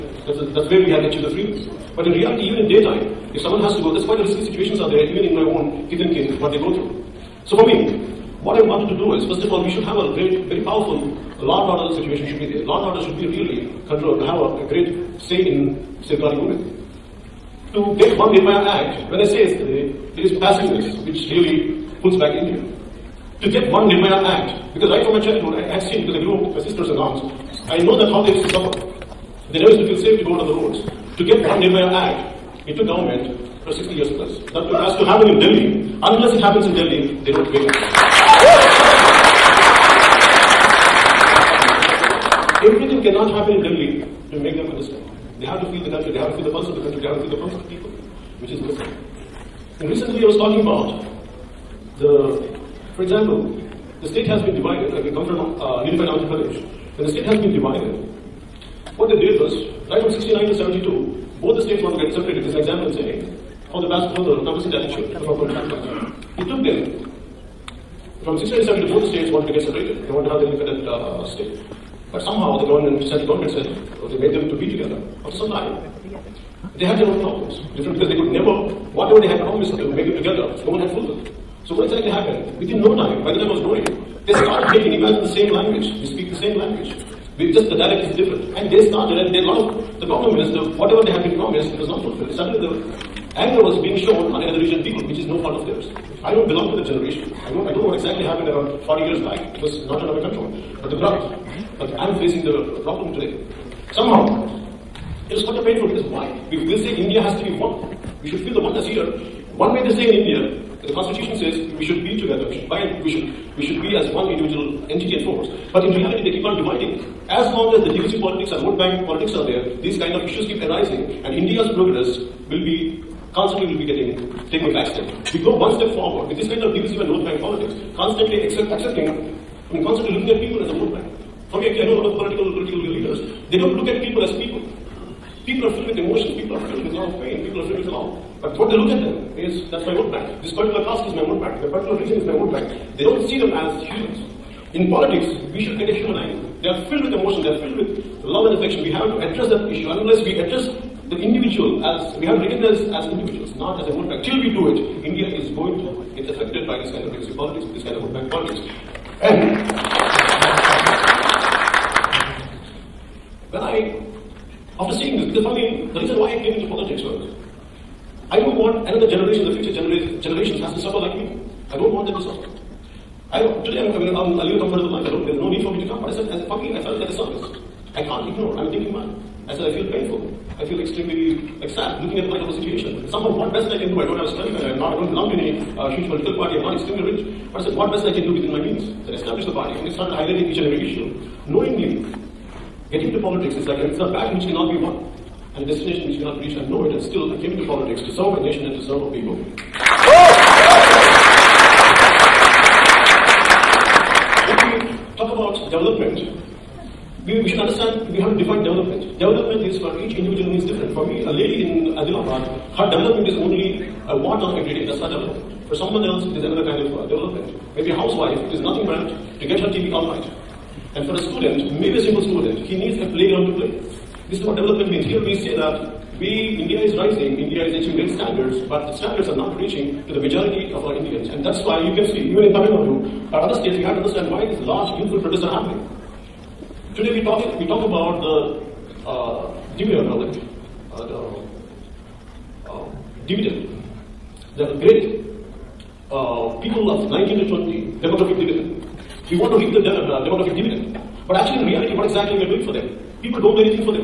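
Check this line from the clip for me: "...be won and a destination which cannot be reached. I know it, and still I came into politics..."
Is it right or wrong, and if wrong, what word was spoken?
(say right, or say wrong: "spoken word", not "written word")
right.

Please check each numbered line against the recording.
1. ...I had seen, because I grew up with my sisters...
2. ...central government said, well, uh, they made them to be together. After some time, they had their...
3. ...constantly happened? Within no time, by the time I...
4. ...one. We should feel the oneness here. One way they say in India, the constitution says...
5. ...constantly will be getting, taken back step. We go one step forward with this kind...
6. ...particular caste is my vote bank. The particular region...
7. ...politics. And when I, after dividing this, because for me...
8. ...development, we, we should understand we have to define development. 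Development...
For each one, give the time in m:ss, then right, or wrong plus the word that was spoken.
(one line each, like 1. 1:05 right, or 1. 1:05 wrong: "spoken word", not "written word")
1. 0:25 right
2. 1:13 right
3. 1:21 wrong: "exactly", not "constantly"
4. 1:47 right
5. 2:03 right
6. 2:20 right
7. 2:38 wrong: "seeing", not "dividing"
8. 3:25 right.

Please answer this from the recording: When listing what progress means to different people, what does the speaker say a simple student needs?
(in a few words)
A playground.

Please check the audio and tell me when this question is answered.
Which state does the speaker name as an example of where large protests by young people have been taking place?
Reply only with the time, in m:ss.
3:52.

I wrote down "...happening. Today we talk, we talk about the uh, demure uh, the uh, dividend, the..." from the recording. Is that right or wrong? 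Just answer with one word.
right.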